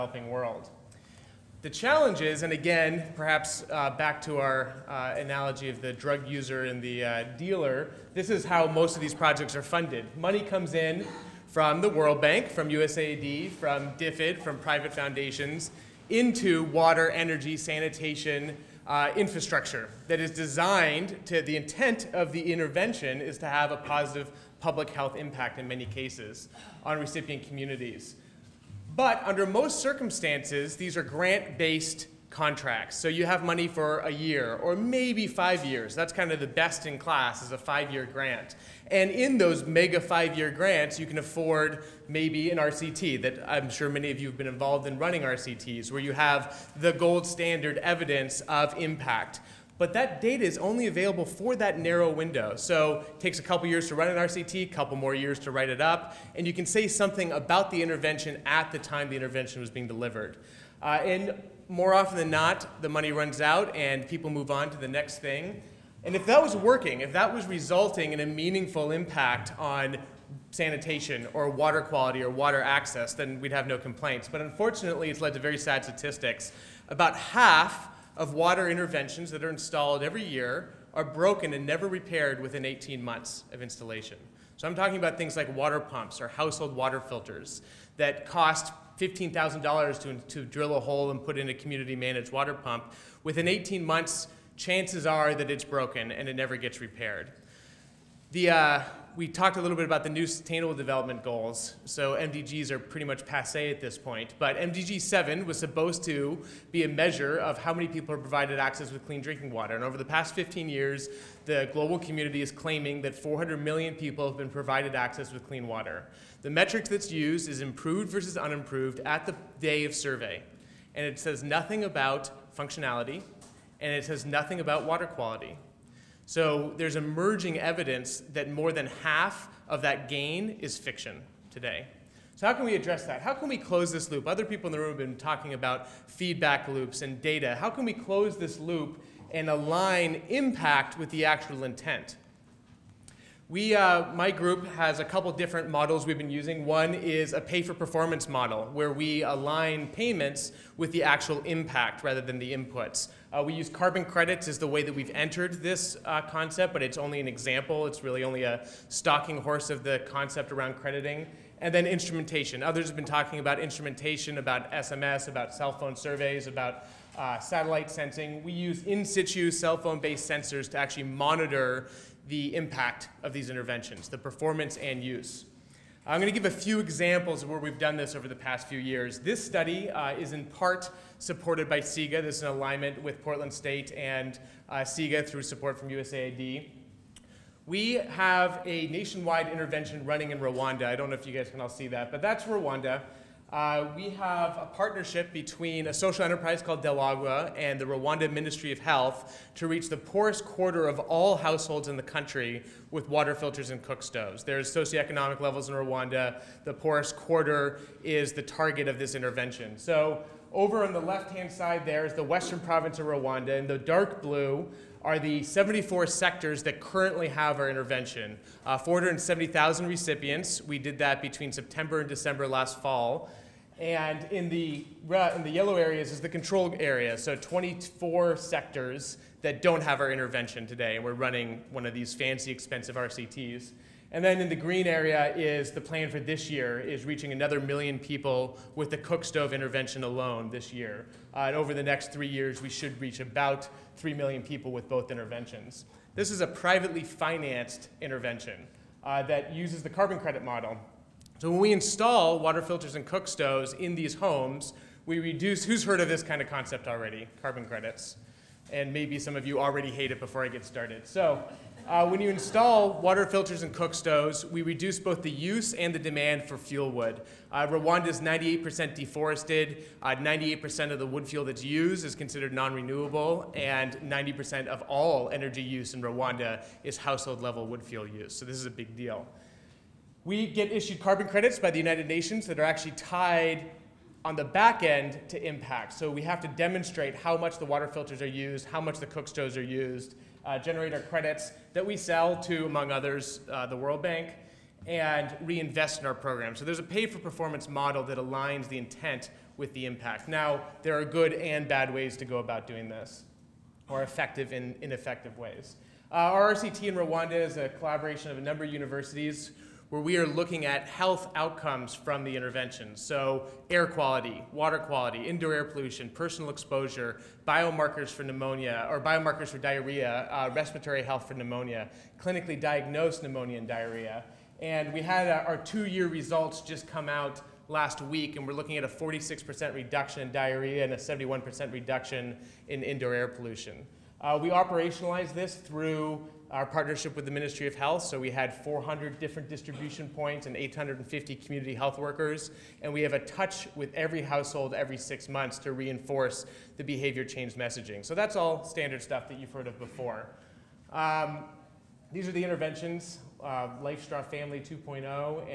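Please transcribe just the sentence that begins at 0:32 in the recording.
So you have money for a year or maybe five years.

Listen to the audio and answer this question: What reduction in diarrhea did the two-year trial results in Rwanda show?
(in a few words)
46%.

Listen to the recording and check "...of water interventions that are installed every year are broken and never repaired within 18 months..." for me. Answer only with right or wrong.
right.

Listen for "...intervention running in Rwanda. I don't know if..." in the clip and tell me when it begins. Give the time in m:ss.
3:09.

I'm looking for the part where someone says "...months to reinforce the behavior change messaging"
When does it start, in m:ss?
5:45.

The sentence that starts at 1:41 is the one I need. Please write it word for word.
So MDGs are pretty much passe at this point.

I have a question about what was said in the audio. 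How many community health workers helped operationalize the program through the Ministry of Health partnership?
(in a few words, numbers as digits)
850.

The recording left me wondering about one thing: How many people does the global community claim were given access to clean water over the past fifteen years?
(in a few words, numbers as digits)
400 million.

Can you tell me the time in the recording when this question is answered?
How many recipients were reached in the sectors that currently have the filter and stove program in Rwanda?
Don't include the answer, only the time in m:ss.
3:38.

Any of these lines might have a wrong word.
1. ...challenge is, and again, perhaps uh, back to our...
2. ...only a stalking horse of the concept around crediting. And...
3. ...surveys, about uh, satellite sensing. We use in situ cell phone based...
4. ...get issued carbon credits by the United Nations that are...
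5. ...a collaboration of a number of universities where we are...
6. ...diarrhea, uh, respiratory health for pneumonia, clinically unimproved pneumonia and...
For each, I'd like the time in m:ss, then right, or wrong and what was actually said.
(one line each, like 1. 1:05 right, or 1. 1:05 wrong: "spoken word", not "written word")
1. 0:01 right
2. 2:38 right
3. 2:45 right
4. 4:40 right
5. 5:07 right
6. 5:19 wrong: "diagnosed", not "unimproved".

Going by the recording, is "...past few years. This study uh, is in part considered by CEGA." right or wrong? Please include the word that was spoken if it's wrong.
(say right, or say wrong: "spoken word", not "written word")
wrong: "supported", not "considered".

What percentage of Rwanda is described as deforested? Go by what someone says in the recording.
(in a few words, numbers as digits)
98%.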